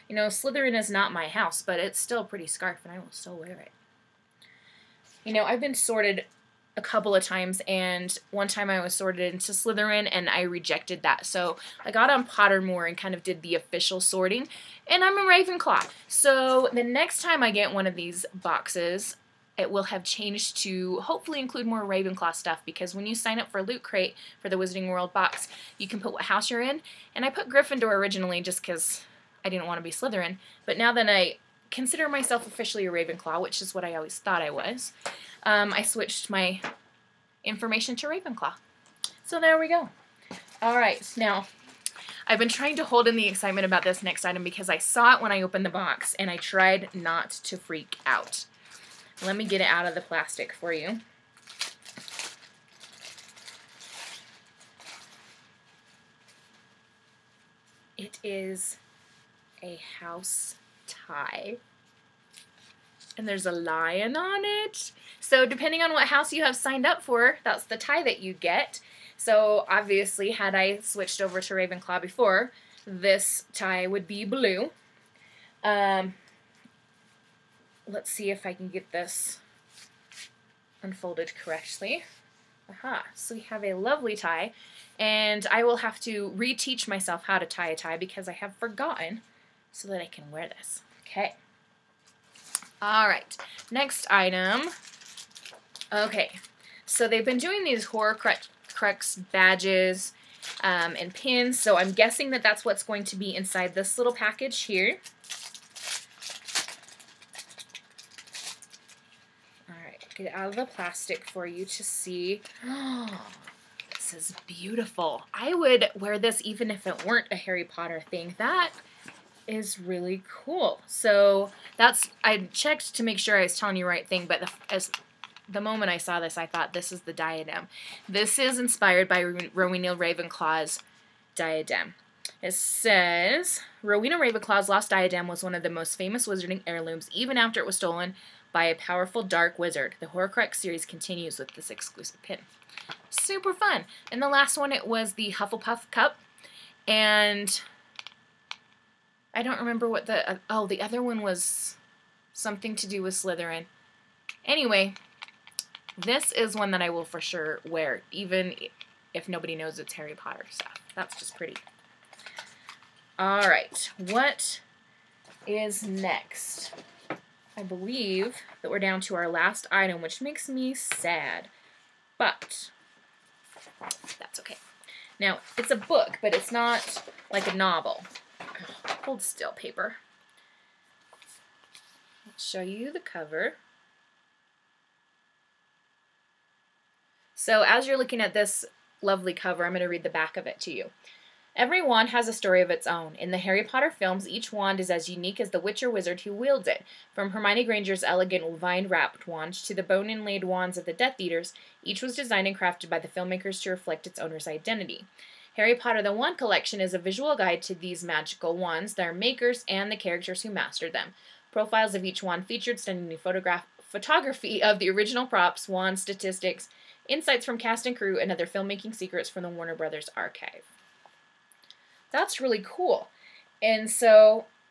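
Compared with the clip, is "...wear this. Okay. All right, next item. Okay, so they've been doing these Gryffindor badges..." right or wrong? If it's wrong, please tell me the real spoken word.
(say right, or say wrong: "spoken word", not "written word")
wrong: "Horcrux", not "Gryffindor".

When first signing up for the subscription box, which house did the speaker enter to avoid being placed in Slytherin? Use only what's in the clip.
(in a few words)
Gryffindor.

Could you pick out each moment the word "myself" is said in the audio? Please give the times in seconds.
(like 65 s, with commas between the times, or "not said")
32 s, 86 s.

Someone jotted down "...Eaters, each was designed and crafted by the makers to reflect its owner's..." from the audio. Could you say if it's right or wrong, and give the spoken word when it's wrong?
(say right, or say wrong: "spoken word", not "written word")
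wrong: "filmmakers", not "makers".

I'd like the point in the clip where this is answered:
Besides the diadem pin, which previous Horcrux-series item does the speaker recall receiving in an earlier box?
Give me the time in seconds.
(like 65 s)
145 s.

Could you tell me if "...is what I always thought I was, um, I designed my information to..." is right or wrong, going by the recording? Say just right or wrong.
wrong.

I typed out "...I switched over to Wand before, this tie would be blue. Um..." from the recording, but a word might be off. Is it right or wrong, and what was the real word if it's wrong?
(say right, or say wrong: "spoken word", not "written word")
wrong: "Ravenclaw", not "Wand".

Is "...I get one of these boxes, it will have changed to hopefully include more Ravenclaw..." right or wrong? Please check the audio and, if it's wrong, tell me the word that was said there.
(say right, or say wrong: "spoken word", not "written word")
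right.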